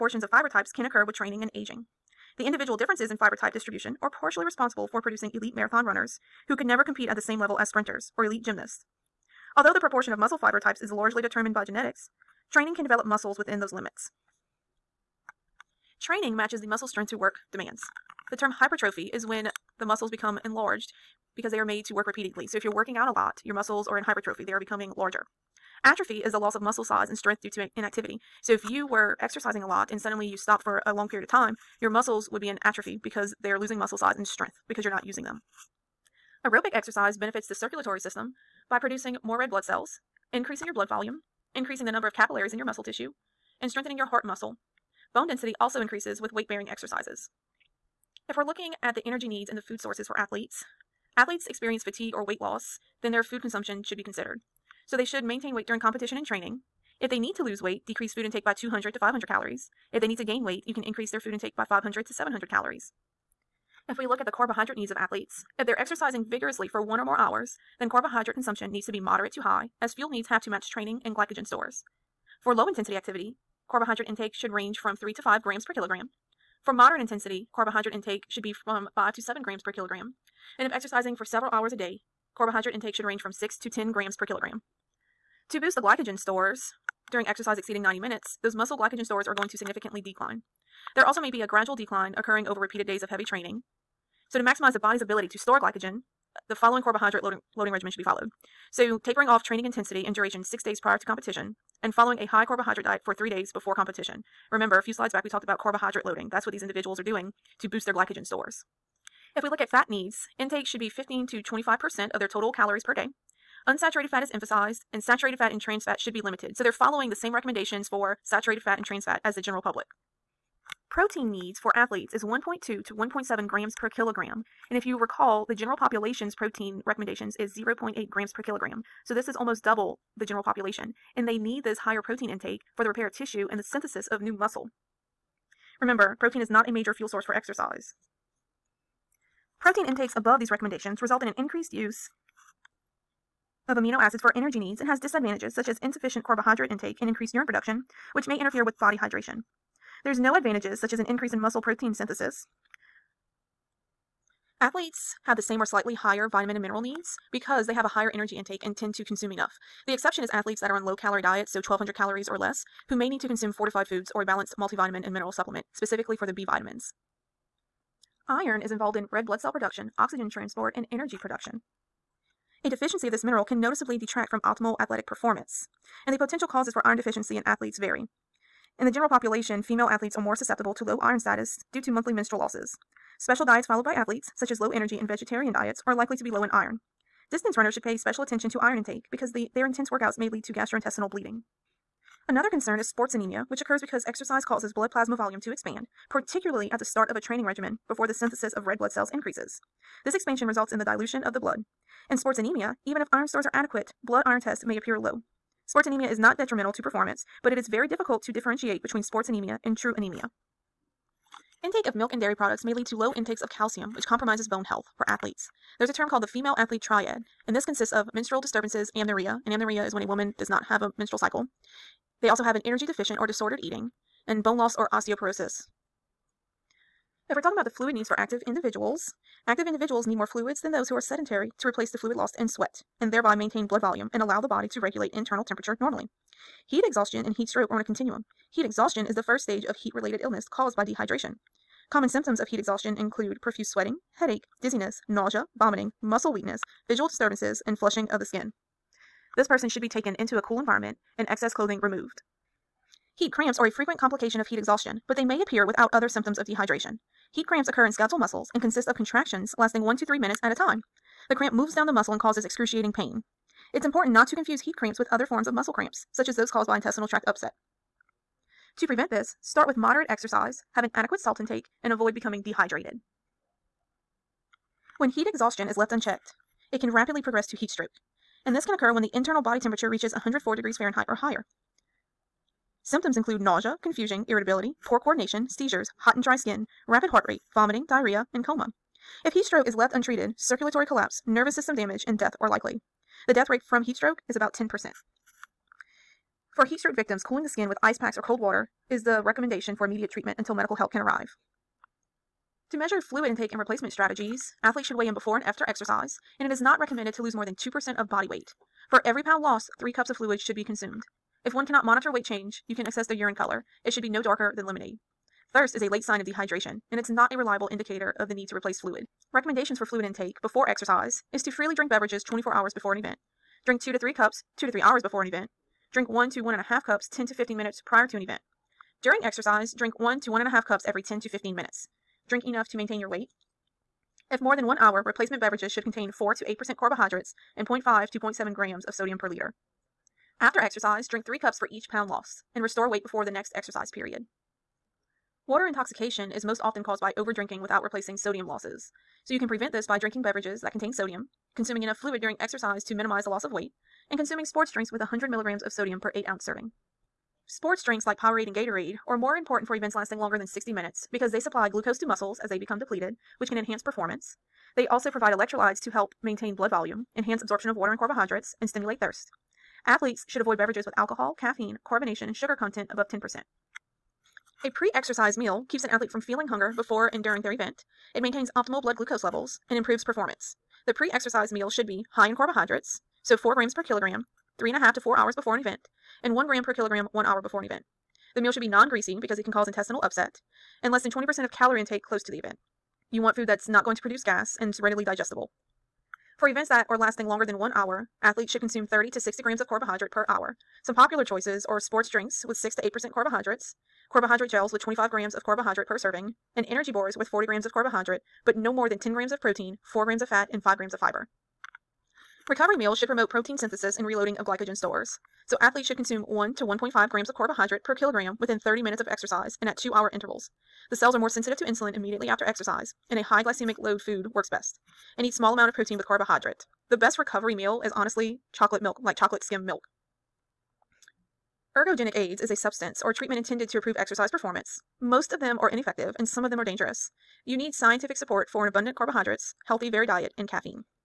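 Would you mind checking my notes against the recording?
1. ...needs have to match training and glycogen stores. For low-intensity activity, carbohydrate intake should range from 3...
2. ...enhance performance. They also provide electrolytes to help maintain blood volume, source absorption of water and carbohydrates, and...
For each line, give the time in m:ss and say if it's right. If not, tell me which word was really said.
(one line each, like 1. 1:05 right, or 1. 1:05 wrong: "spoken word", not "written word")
1. 1:10 right
2. 6:03 wrong: "enhance", not "source".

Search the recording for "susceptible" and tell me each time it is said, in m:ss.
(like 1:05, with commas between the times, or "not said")
3:00.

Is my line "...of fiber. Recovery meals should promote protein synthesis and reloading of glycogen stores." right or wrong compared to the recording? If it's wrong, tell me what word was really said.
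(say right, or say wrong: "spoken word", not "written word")
right.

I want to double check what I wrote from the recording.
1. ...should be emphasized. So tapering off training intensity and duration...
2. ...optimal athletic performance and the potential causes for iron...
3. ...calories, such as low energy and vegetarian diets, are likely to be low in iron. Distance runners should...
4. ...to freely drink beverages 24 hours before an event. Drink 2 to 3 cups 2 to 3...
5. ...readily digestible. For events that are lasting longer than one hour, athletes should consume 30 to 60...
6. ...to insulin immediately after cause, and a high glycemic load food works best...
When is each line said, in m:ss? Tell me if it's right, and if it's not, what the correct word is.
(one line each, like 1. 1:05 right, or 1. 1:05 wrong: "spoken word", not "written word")
1. 1:37 wrong: "followed", not "emphasized"
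2. 2:54 right
3. 3:03 wrong: "athletes", not "calories"
4. 5:21 right
5. 6:34 right
6. 7:01 wrong: "exercise", not "cause".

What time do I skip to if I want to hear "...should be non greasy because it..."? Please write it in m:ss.
6:28.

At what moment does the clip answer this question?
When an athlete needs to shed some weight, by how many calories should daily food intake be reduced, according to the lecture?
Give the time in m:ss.
0:58.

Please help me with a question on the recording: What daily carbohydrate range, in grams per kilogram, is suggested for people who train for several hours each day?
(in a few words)
6 to 10.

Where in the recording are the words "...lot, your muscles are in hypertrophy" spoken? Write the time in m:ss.
0:23.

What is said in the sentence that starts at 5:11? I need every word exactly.
If one cannot monitor weight change, you can assess the urine color.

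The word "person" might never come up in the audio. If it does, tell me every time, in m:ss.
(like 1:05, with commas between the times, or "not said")
4:09.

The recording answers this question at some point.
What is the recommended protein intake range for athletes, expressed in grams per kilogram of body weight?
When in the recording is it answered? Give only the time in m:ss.
2:02.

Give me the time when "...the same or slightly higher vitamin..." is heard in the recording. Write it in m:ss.
2:35.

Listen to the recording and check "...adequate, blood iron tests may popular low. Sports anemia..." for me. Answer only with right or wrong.
wrong.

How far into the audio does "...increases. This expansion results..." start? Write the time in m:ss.
3:19.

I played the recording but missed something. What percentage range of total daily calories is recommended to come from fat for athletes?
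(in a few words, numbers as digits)
15 to 25%.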